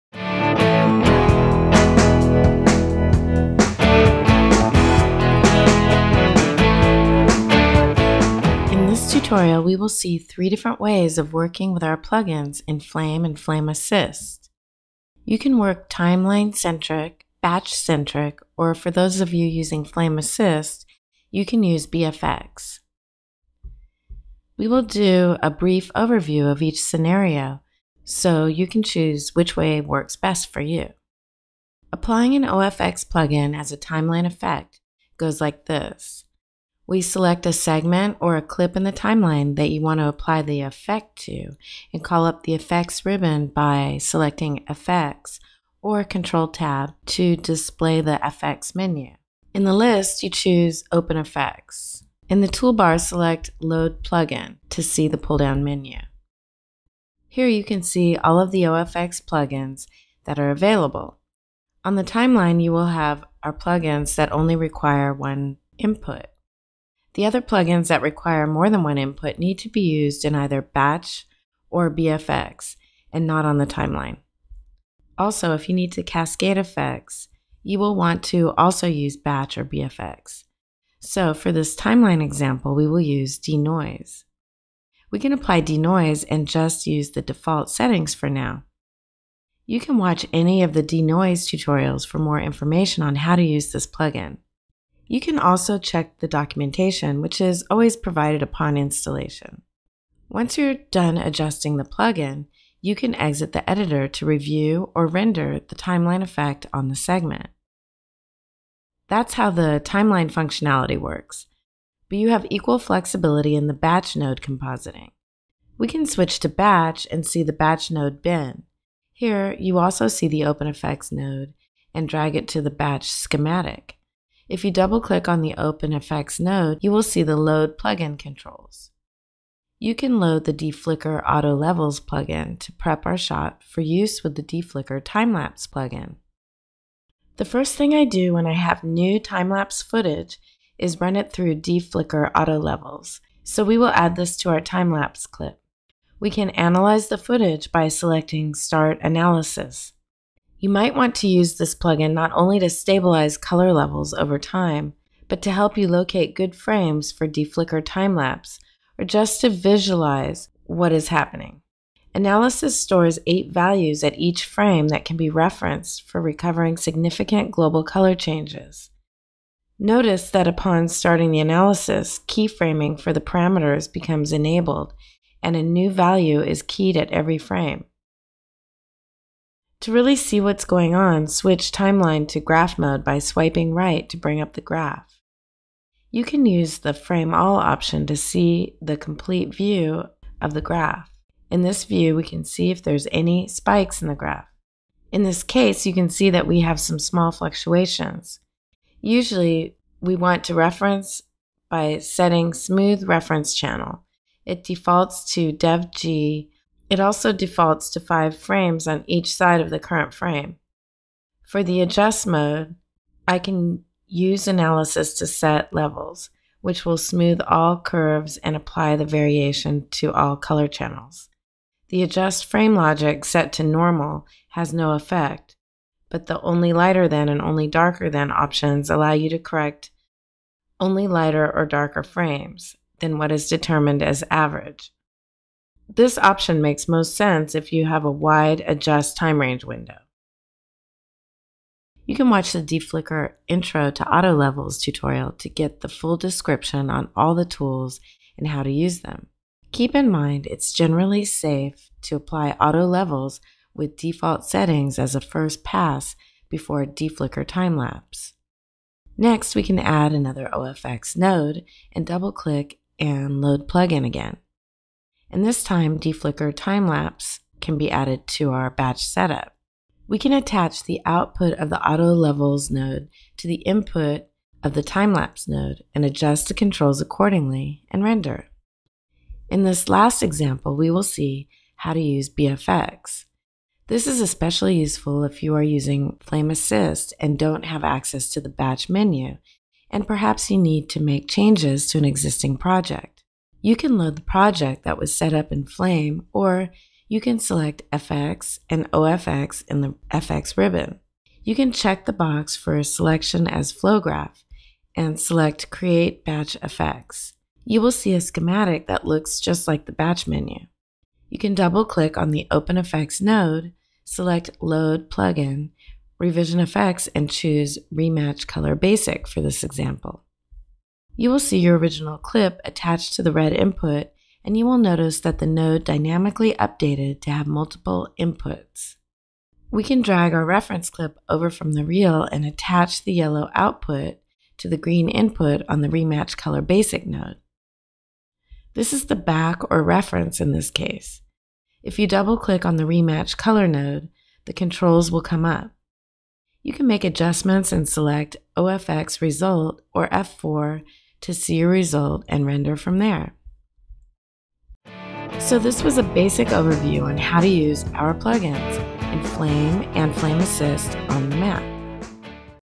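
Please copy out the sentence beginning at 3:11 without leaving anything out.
In this view, we can see if there's any spikes in the graph.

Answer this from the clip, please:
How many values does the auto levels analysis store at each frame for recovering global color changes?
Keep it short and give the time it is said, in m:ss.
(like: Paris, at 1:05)
8, at 2:43.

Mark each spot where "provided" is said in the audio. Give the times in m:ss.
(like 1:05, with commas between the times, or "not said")
1:37.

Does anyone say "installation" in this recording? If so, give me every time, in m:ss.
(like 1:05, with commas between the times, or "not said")
1:38.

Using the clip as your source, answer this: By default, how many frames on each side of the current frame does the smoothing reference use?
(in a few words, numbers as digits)
5.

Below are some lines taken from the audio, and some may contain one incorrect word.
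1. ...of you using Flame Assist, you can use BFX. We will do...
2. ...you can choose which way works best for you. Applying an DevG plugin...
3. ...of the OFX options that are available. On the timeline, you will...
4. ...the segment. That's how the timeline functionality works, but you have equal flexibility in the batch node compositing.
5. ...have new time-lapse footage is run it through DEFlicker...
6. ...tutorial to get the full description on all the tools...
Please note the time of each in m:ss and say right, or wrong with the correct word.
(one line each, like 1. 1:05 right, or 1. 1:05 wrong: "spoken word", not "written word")
1. 0:19 right
2. 0:28 wrong: "OFX", not "DevG"
3. 0:58 wrong: "plugins", not "options"
4. 1:46 right
5. 2:18 right
6. 4:04 right.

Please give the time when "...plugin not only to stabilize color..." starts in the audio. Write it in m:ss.
2:31.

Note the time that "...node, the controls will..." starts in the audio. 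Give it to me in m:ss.
5:43.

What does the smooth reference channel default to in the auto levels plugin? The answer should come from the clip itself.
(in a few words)
DevG.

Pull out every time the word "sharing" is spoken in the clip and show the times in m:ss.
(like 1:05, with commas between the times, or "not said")
not said.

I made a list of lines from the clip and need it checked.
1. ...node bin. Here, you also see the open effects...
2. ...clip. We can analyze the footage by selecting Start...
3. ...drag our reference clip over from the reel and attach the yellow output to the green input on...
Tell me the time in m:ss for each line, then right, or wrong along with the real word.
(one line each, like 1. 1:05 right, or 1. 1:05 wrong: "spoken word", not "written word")
1. 1:57 right
2. 2:25 right
3. 5:30 right.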